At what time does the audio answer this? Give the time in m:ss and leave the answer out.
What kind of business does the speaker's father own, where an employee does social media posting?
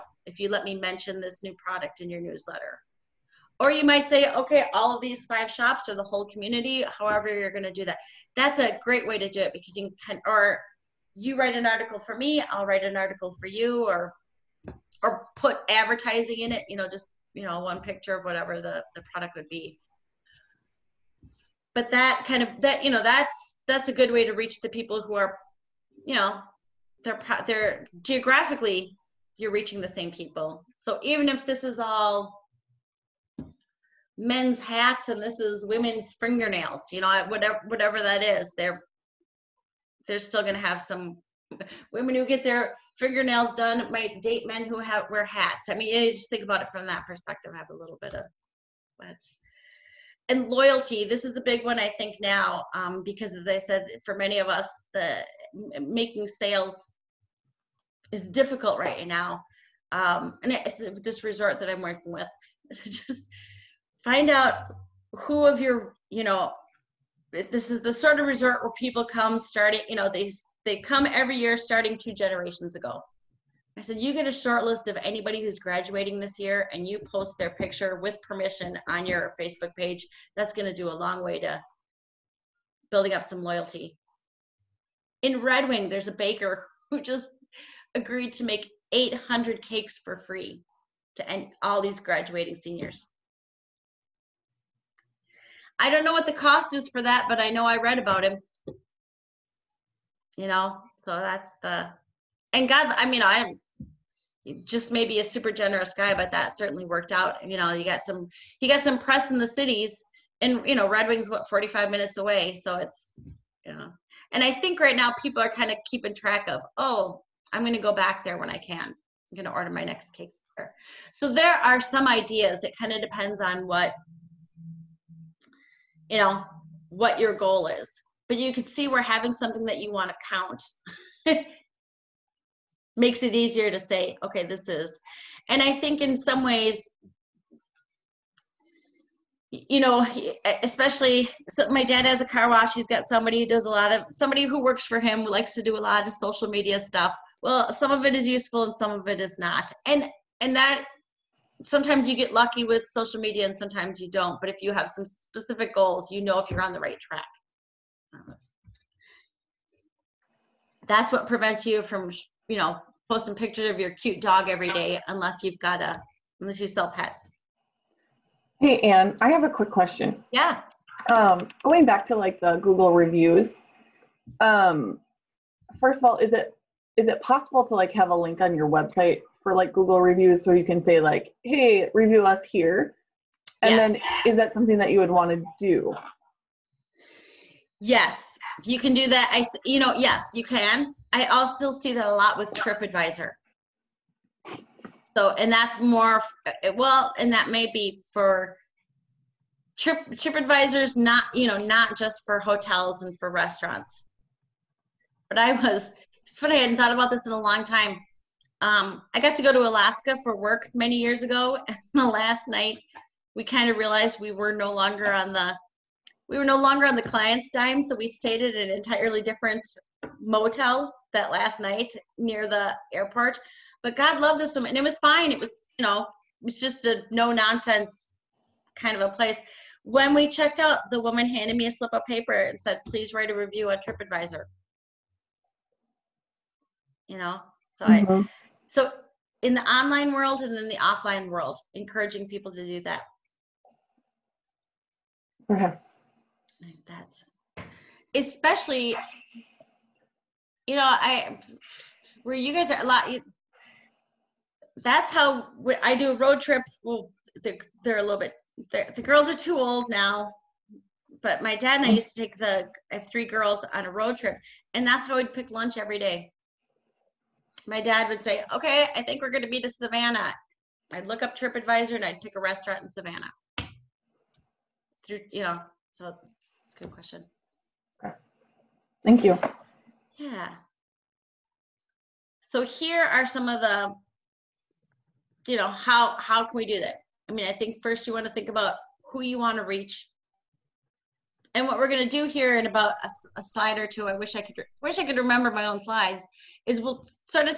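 2:22.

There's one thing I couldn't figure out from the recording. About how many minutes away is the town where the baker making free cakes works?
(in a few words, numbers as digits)
45 minutes.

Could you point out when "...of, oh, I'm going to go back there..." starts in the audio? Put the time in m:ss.
1:56.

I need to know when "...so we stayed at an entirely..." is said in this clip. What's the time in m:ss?
3:37.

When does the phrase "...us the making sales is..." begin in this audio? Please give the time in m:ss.
0:54.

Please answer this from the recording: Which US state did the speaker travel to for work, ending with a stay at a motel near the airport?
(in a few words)
Alaska.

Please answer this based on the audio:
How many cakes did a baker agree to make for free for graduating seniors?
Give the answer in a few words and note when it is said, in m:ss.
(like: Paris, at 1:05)
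800, at 1:28.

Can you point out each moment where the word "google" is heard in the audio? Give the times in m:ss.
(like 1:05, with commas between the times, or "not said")
2:52, 2:59.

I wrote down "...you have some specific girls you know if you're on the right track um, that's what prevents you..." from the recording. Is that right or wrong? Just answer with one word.
wrong.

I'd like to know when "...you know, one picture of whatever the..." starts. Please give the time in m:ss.
0:17.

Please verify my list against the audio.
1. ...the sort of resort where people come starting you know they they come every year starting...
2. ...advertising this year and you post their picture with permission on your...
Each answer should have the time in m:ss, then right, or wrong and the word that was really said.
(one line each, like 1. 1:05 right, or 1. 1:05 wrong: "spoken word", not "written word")
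1. 1:07 right
2. 1:15 wrong: "graduating", not "advertising".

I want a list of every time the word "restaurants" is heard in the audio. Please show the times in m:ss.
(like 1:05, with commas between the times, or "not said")
3:23, 4:32.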